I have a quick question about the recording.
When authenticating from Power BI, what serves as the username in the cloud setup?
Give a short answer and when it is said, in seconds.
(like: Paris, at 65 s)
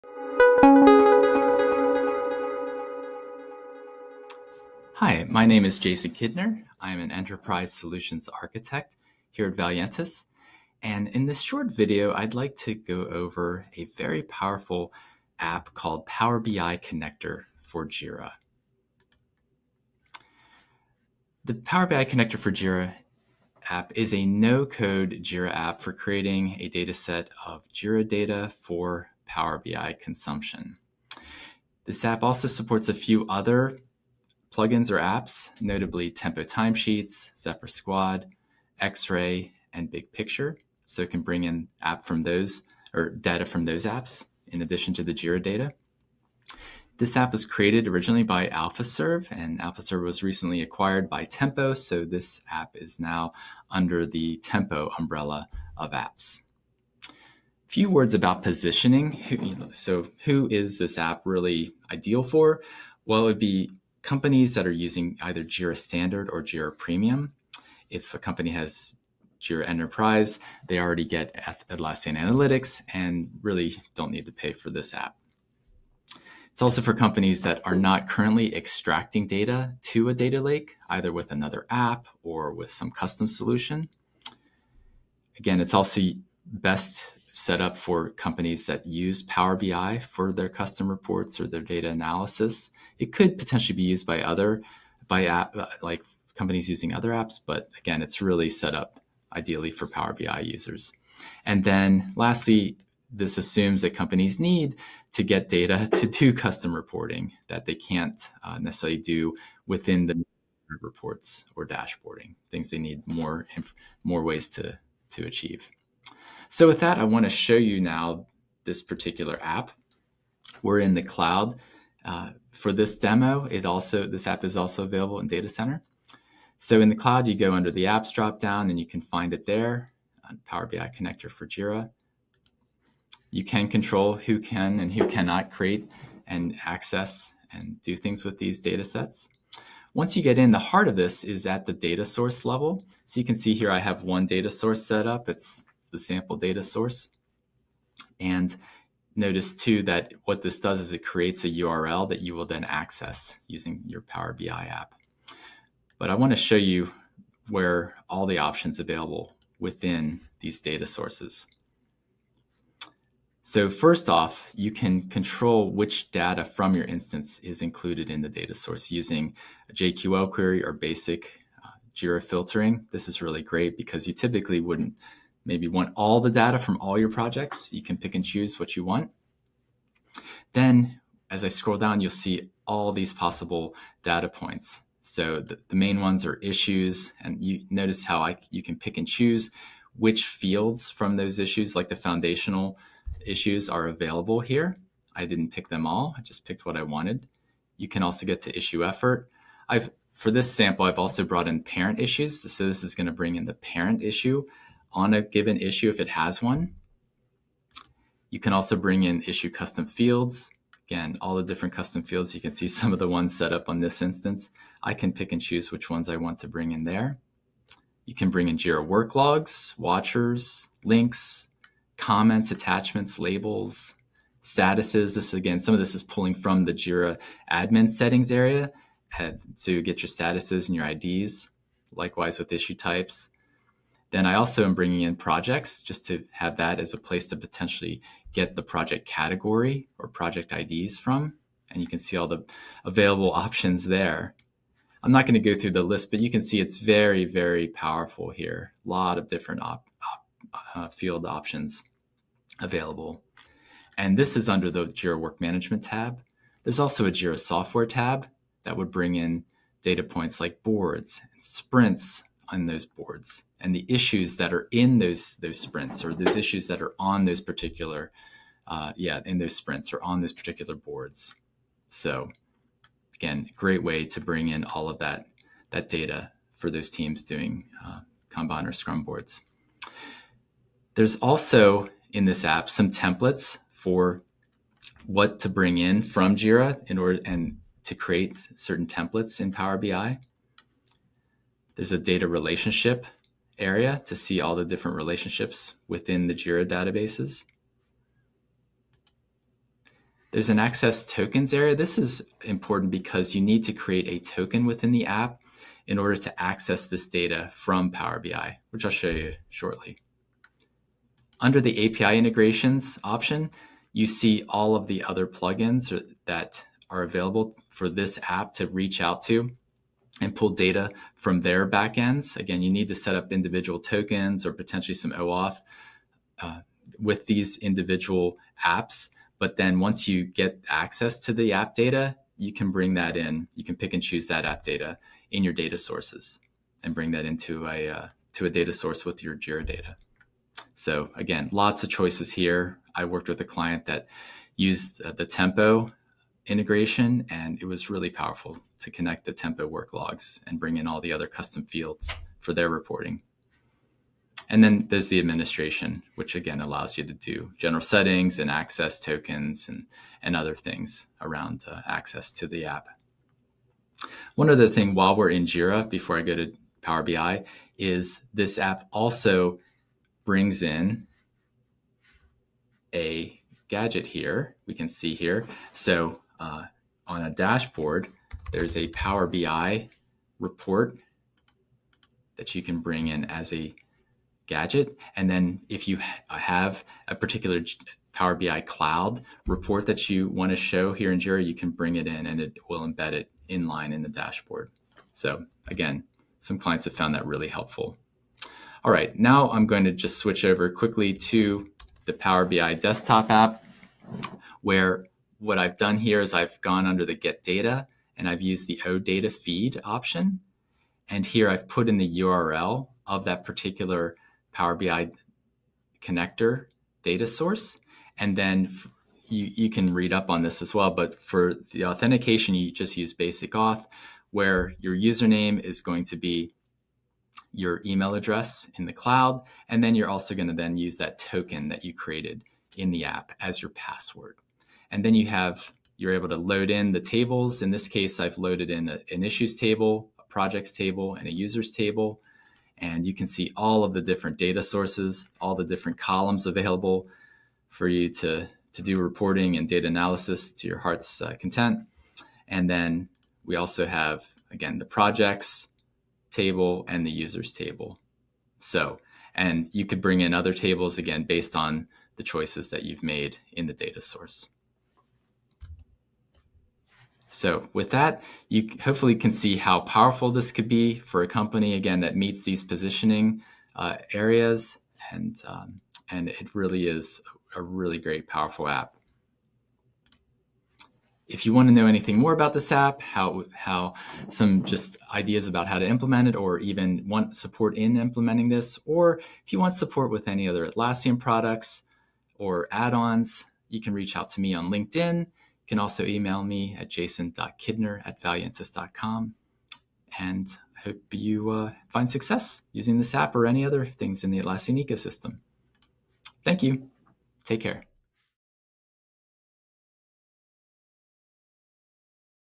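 email address, at 427 s.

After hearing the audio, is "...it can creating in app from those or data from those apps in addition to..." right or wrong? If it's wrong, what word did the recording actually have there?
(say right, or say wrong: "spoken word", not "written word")
wrong: "bring", not "creating".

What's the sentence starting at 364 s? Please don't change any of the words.
One other thing while we're in Jira, before I go to Power BI, is this app also brings in a gadget here.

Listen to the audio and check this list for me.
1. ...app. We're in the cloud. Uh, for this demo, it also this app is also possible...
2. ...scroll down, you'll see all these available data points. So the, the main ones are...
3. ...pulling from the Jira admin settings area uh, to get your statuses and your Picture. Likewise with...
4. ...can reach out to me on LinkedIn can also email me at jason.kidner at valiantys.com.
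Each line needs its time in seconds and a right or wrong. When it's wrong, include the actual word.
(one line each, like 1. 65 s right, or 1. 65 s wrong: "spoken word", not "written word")
1. 119 s wrong: "available", not "possible"
2. 181 s wrong: "possible", not "available"
3. 226 s wrong: "IDs", not "Picture"
4. 493 s right.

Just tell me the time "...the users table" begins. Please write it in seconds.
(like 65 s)
457 s.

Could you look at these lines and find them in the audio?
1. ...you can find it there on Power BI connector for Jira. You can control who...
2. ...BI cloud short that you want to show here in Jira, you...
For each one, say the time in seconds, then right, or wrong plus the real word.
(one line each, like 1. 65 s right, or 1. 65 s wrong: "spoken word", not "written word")
1. 128 s right
2. 388 s wrong: "report", not "short".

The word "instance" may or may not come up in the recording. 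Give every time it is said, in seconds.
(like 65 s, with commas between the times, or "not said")
166 s, 214 s.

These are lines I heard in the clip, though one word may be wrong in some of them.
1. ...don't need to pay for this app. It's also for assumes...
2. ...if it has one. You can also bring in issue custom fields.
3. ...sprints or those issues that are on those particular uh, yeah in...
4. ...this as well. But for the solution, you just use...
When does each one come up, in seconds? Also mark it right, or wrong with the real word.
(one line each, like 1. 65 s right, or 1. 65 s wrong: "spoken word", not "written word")
1. 73 s wrong: "companies", not "assumes"
2. 205 s right
3. 265 s right
4. 420 s wrong: "authentication", not "solution".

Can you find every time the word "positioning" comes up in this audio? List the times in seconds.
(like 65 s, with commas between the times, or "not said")
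58 s, 472 s.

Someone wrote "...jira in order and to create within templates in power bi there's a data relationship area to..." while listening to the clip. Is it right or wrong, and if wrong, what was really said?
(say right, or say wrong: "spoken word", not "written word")
wrong: "certain", not "within".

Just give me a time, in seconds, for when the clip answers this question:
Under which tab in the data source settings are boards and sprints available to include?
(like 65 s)
257 s.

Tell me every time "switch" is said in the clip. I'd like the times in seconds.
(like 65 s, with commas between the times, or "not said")
400 s.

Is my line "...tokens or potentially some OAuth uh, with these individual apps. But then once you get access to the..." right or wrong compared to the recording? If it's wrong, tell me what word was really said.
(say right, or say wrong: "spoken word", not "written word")
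right.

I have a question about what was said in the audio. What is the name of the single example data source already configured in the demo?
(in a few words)
sample data source.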